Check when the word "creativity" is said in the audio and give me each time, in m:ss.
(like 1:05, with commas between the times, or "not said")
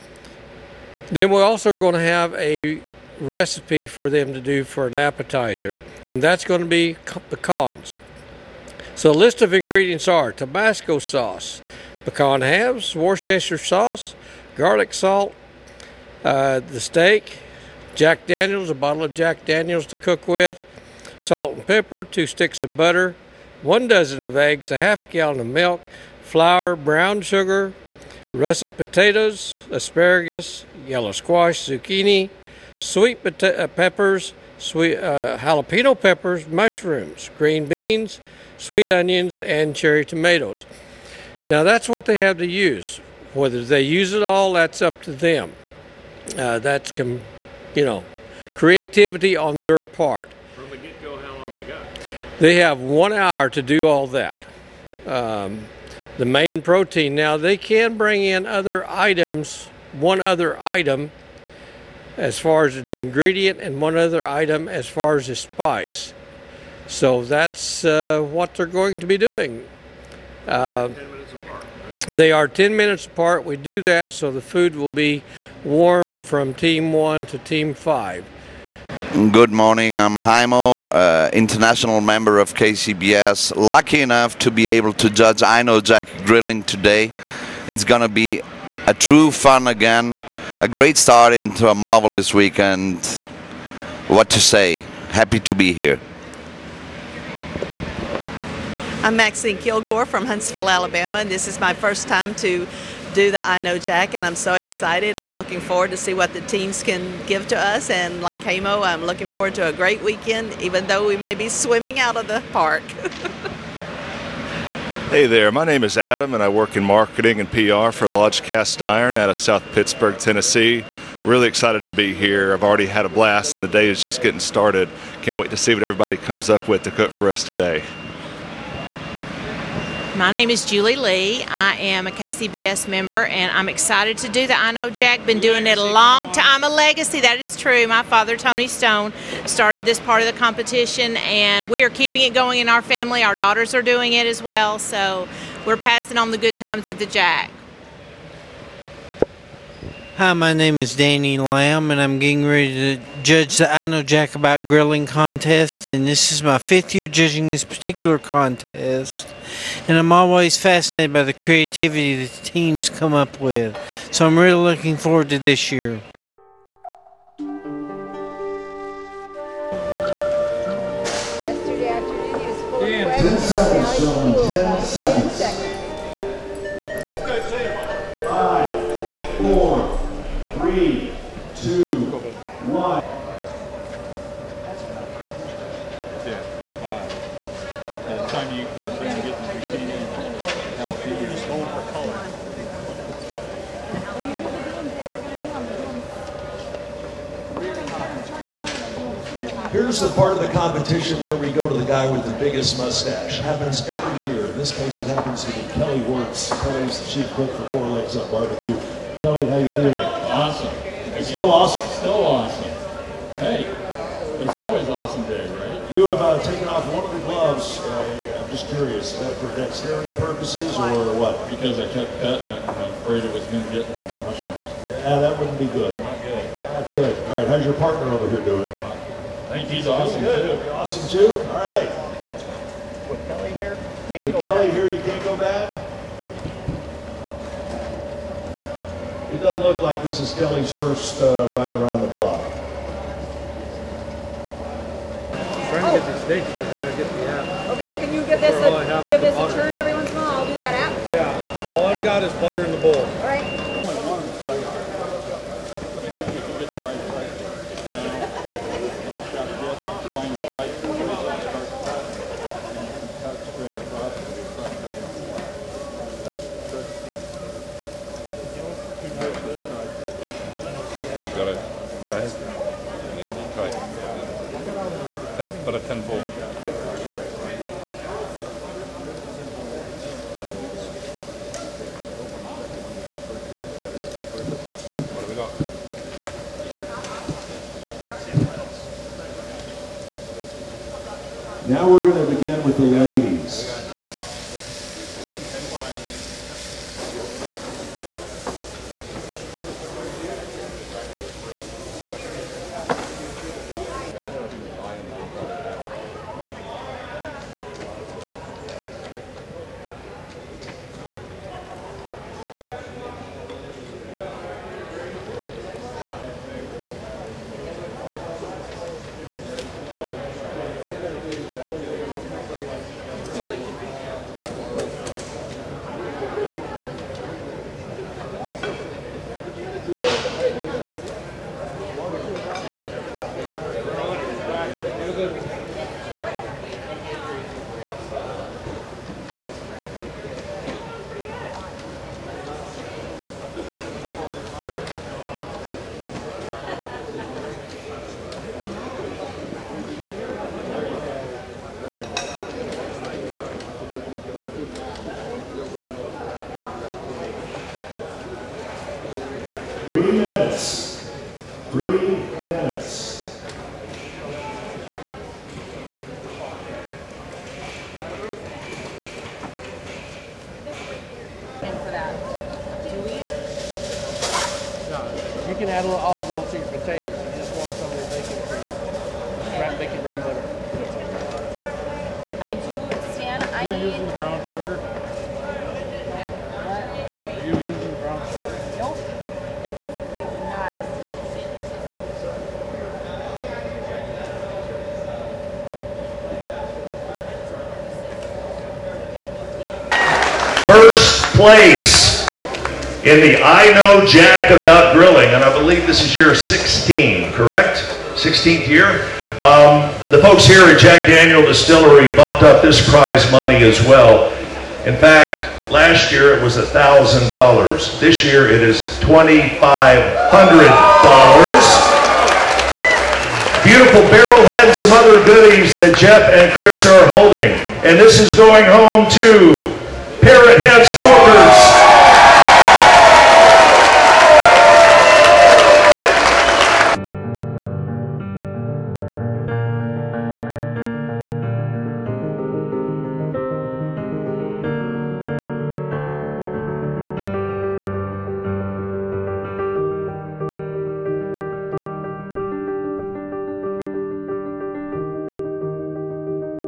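0:48, 2:41.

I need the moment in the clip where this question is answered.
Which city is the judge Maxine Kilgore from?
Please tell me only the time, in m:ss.
1:40.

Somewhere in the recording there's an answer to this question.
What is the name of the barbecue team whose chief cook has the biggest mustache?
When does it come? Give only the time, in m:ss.
3:27.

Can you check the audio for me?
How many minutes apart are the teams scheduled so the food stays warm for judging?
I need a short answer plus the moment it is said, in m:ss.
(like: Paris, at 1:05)
10, at 1:12.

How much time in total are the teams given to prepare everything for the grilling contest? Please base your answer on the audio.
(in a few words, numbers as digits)
One hour.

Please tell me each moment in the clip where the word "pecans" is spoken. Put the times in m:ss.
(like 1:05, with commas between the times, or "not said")
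0:07, 0:12.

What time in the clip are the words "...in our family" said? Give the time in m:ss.
2:22.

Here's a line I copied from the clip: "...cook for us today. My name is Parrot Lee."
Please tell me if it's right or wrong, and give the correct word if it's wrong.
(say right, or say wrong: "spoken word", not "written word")
wrong: "Julie", not "Parrot".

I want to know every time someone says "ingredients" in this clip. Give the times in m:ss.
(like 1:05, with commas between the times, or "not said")
0:09, 1:02.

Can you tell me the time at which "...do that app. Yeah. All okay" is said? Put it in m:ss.
4:10.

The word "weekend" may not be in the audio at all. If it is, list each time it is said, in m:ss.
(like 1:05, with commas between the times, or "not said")
1:32, 1:50.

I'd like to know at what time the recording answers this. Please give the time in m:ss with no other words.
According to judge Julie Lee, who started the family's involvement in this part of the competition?
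2:18.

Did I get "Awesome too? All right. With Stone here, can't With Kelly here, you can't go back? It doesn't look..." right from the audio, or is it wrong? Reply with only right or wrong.
wrong.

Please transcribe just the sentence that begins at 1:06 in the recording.
So that's uh, what they're going to be doing.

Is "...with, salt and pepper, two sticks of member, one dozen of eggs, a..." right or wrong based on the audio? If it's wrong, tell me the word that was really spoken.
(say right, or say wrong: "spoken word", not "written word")
wrong: "butter", not "member".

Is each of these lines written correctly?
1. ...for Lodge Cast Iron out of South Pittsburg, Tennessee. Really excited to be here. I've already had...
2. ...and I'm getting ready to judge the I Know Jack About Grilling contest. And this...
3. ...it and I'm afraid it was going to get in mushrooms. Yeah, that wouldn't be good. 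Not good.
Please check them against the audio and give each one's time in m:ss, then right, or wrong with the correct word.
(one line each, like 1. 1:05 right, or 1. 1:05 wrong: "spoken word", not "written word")
1. 1:57 right
2. 2:31 right
3. 3:42 right.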